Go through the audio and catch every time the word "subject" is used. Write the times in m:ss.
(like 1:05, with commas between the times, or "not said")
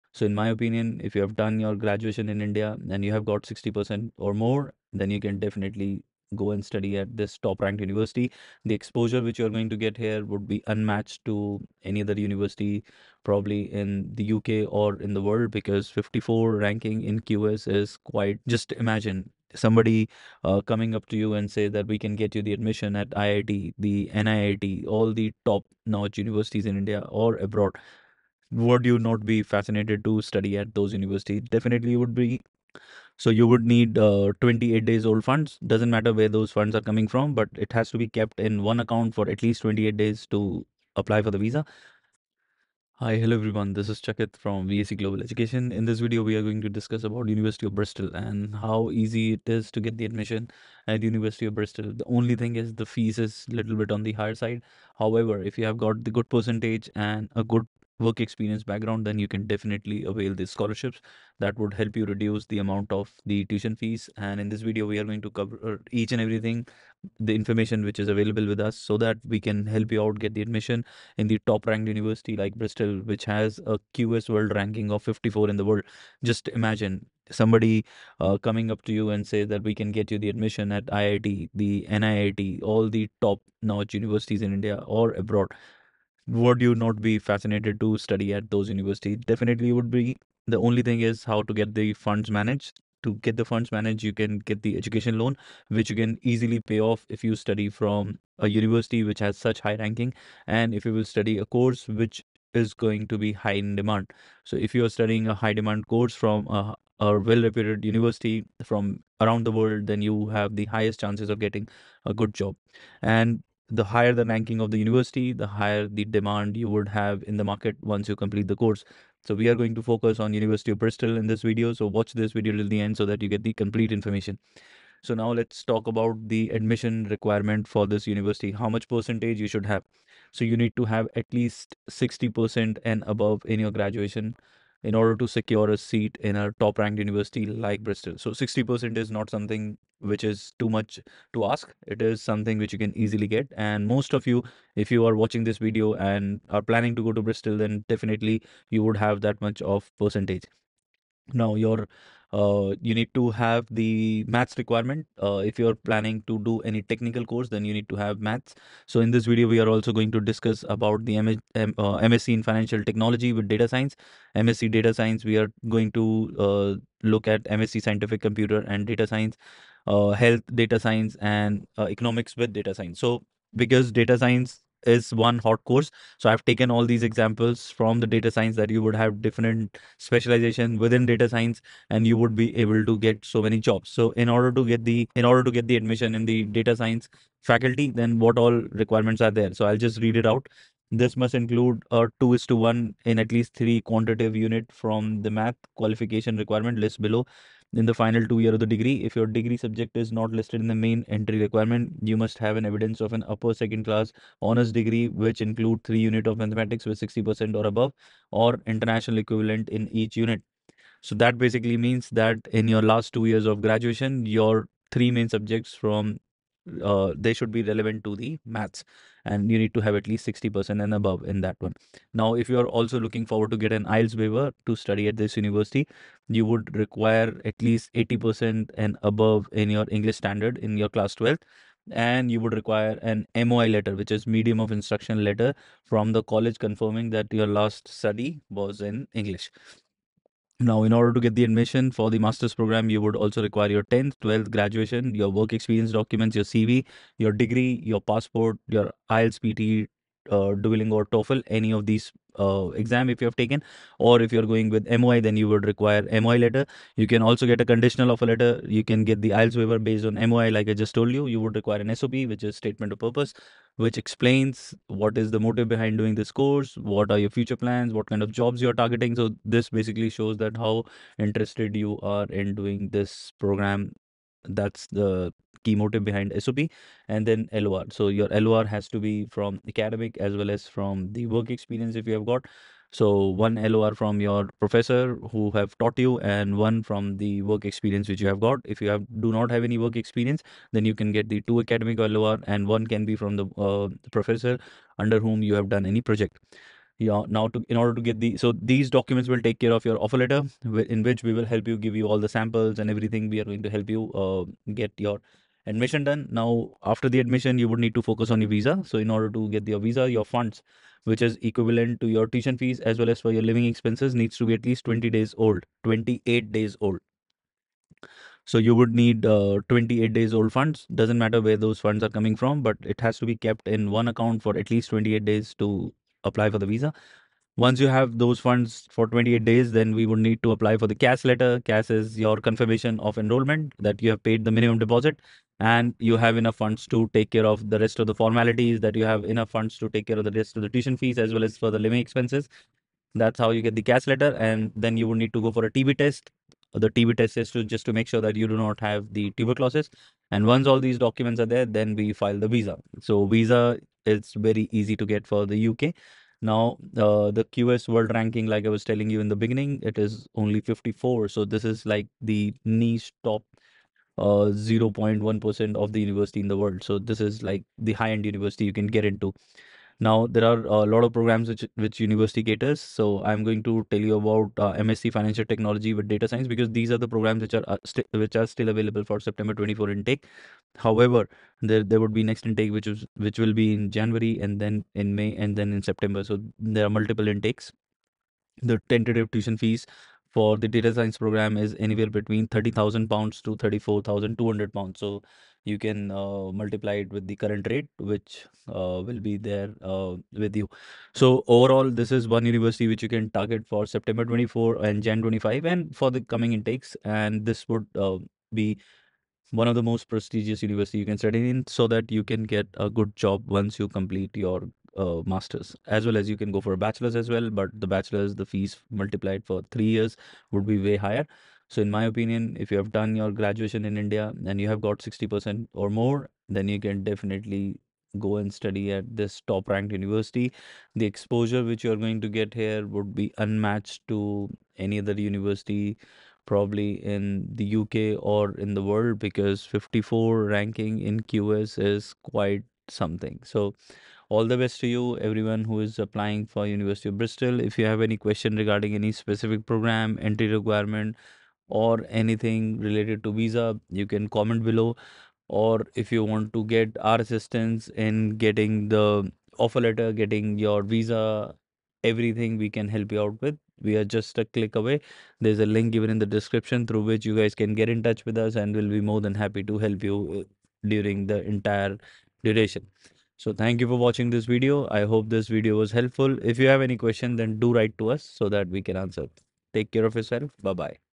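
3:19, 3:35.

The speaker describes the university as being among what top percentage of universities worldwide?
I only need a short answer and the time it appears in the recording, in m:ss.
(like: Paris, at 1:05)
0.1%, at 6:04.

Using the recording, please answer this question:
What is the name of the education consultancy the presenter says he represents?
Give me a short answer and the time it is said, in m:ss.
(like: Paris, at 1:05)
VAC Global Education, at 0:44.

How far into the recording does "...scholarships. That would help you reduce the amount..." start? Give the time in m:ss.
1:00.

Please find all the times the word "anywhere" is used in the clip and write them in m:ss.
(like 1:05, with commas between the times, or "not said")
6:31.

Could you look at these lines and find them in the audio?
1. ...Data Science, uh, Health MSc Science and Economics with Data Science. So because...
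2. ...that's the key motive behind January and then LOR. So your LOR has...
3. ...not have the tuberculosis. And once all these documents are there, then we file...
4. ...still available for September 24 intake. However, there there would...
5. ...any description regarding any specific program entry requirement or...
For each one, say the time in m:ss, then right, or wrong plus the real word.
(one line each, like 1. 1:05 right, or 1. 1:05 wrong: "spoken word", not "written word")
1. 2:48 wrong: "Data", not "MSc"
2. 4:34 wrong: "SOP", not "January"
3. 5:48 right
4. 6:18 right
5. 7:28 wrong: "question", not "description".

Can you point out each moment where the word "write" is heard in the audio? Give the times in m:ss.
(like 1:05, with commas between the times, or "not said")
7:57.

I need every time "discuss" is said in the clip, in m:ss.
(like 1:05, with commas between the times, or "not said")
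0:46, 2:40.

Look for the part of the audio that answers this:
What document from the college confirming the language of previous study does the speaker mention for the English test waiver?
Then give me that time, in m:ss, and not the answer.
3:54.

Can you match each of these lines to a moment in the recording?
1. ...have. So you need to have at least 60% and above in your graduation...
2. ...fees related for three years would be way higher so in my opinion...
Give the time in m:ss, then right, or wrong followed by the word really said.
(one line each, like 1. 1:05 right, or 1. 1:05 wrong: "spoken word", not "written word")
1. 2:09 right
2. 6:58 wrong: "multiplied", not "related".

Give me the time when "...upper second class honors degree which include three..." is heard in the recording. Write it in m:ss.
3:23.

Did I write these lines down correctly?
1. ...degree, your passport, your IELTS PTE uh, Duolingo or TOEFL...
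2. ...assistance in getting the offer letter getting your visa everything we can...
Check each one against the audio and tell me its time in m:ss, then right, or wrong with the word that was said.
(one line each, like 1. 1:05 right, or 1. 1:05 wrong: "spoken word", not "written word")
1. 4:07 right
2. 7:37 right.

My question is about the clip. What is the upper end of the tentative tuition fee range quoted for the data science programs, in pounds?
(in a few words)
34,200 pounds.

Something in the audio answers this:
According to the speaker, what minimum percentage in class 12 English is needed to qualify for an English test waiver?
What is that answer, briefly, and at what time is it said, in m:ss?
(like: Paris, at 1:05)
80%, at 3:47.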